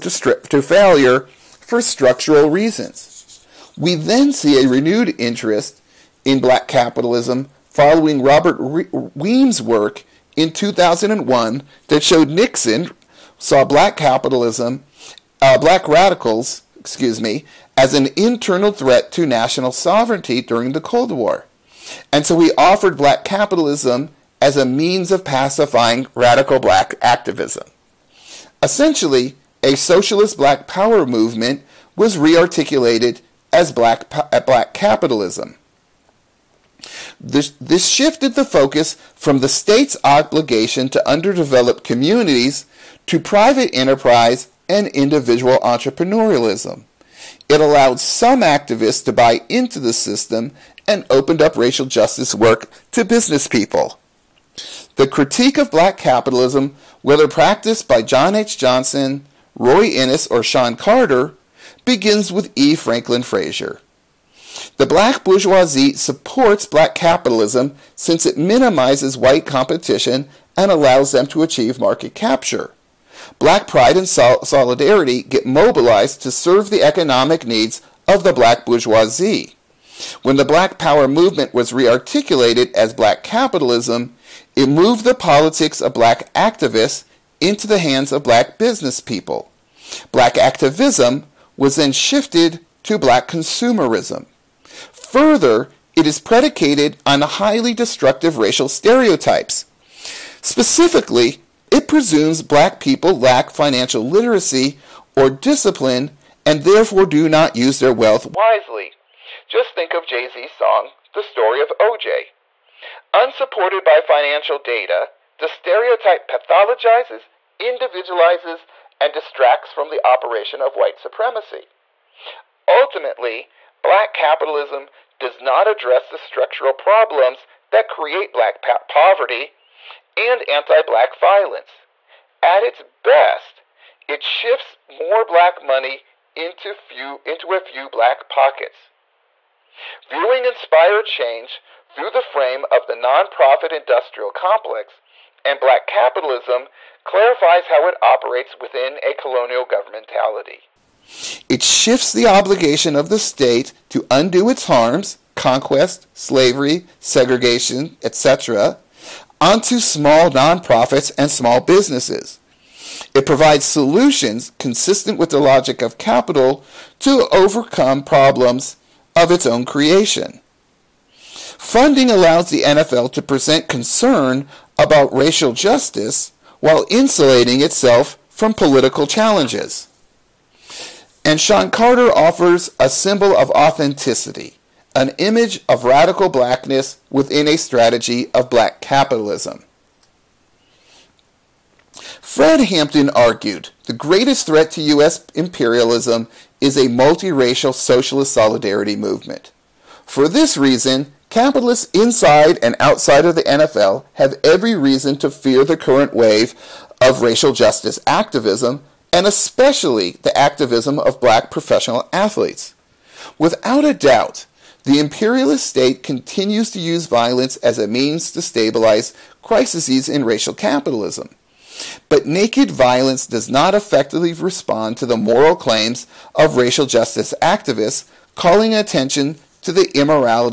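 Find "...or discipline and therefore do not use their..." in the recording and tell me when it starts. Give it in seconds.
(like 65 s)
105 s.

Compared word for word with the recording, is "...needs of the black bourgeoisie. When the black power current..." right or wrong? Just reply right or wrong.
wrong.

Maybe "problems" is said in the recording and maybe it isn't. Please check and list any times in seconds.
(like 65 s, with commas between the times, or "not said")
126 s, 168 s.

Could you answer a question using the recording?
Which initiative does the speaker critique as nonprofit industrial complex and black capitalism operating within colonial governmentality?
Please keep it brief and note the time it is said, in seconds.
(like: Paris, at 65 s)
Inspire Change, at 140 s.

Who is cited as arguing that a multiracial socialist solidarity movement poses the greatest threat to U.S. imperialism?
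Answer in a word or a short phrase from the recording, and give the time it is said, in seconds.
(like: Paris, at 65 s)
Fred Hampton, at 192 s.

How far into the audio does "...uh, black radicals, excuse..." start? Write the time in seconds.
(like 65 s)
15 s.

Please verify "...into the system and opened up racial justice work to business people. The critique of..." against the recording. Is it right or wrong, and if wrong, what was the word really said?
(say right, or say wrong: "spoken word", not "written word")
right.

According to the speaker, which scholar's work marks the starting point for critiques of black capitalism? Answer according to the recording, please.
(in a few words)
E. Franklin Frazier.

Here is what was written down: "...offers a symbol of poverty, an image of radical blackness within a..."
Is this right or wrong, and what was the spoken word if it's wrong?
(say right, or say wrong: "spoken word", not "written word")
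wrong: "authenticity", not "poverty".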